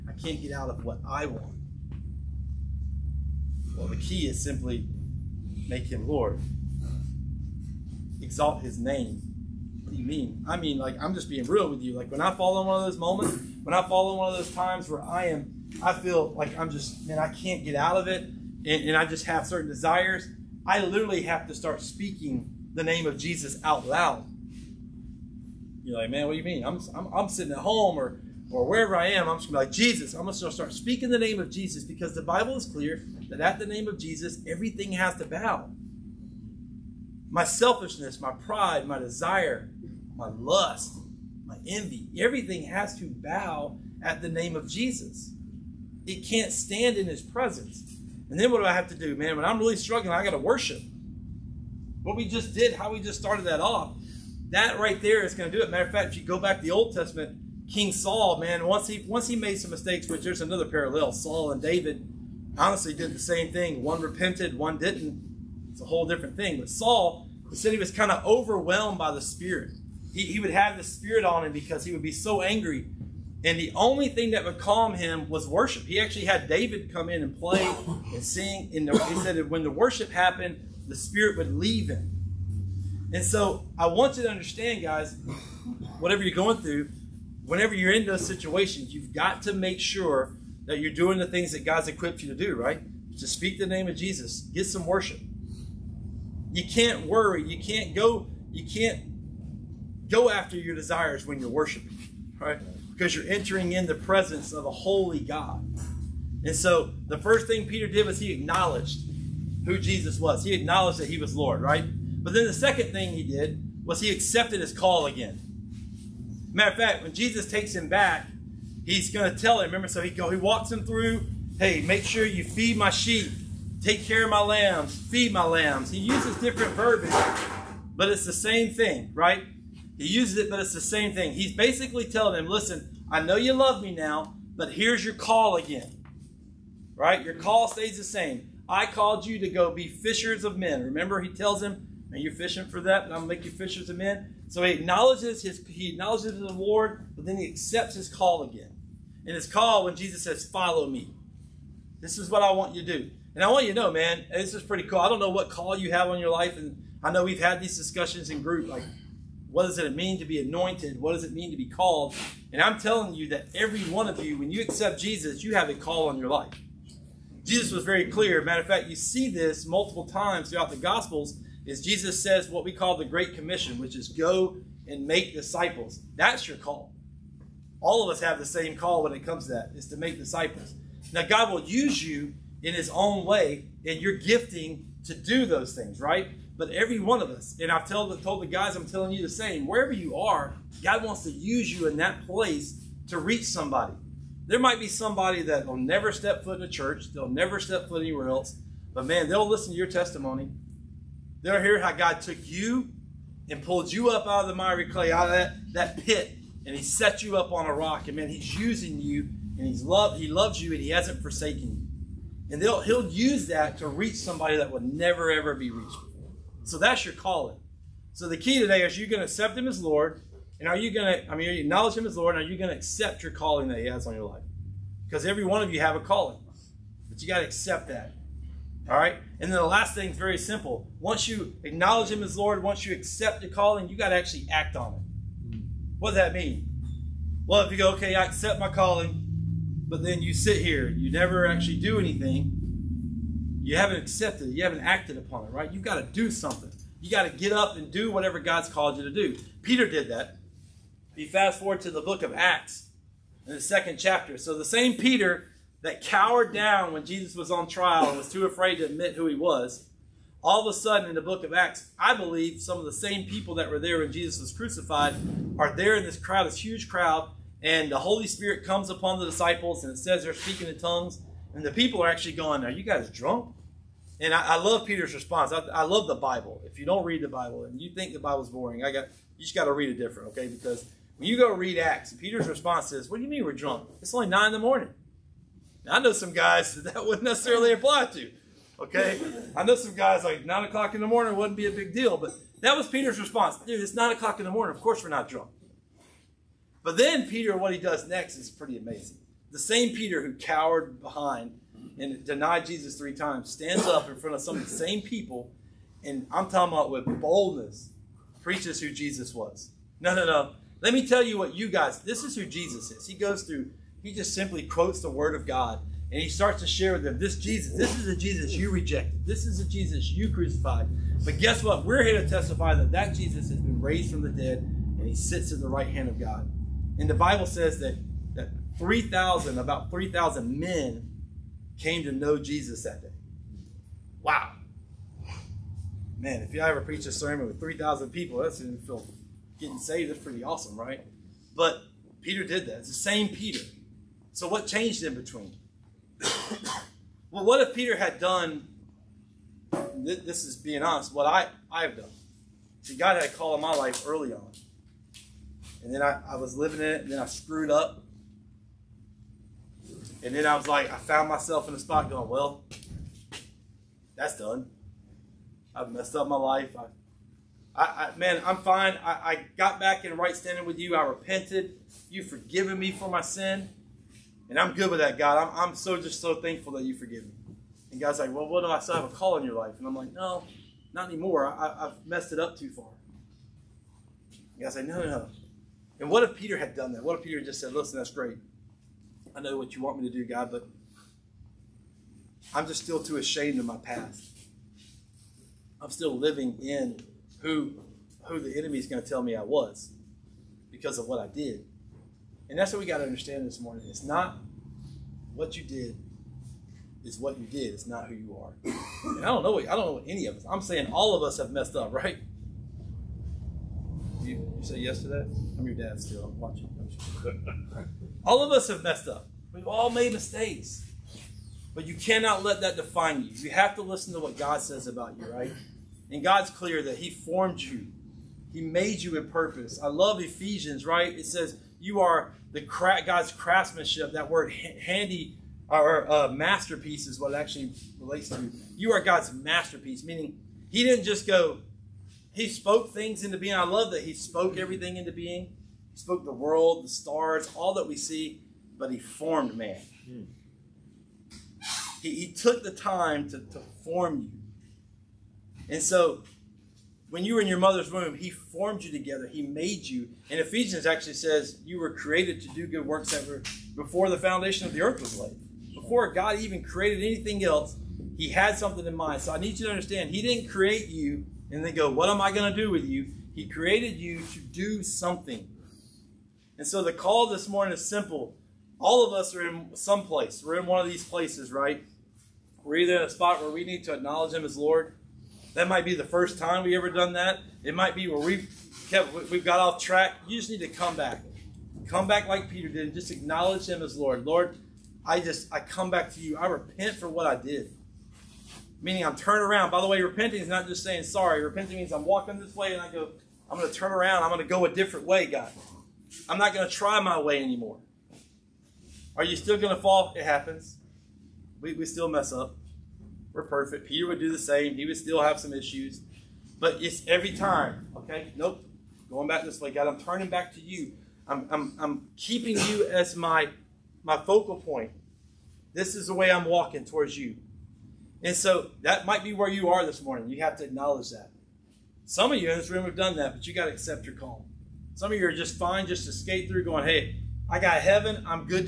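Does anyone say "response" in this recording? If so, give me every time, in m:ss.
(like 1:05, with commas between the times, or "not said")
4:35, 4:42, 4:53.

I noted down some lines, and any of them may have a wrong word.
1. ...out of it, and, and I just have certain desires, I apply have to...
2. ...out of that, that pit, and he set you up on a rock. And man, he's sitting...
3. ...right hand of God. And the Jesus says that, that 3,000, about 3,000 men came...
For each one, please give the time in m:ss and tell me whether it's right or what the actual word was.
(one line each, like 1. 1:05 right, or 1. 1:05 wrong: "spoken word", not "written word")
1. 0:17 wrong: "literally", not "apply"
2. 3:25 wrong: "using", not "sitting"
3. 5:25 wrong: "Bible", not "Jesus".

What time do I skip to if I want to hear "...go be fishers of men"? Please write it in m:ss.
2:19.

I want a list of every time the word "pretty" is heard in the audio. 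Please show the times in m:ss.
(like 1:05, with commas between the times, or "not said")
2:34, 4:58, 5:40.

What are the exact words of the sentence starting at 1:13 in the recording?
And the only thing that would calm him was worship.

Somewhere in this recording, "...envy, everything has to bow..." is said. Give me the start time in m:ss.
0:41.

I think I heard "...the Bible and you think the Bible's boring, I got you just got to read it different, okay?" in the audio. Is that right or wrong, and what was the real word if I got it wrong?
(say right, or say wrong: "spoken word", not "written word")
right.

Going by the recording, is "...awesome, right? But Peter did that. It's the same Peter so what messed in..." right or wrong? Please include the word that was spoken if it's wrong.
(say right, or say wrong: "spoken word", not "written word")
wrong: "changed", not "messed".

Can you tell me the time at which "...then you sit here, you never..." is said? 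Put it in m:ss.
4:00.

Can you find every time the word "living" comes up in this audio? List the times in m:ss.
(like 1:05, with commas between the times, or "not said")
5:56, 6:36.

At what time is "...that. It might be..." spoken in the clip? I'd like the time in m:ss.
8:07.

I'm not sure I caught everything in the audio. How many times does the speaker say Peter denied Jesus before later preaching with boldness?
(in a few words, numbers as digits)
3.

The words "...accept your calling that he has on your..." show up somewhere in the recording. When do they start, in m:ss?
3:42.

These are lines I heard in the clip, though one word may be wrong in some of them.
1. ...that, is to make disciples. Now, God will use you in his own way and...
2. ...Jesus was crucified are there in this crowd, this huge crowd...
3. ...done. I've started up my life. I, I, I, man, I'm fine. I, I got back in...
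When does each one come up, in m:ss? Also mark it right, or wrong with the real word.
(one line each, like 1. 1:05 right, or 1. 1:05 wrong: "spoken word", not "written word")
1. 2:59 right
2. 4:24 right
3. 6:04 wrong: "messed", not "started".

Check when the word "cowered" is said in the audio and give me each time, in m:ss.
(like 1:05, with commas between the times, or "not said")
4:16, 5:00.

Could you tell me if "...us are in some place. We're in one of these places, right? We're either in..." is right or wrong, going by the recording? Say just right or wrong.
right.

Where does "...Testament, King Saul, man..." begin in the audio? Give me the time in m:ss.
0:56.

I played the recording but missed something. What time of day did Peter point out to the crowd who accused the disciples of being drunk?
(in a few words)
9 in the morning.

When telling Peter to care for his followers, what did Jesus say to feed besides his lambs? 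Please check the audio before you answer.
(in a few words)
my sheep.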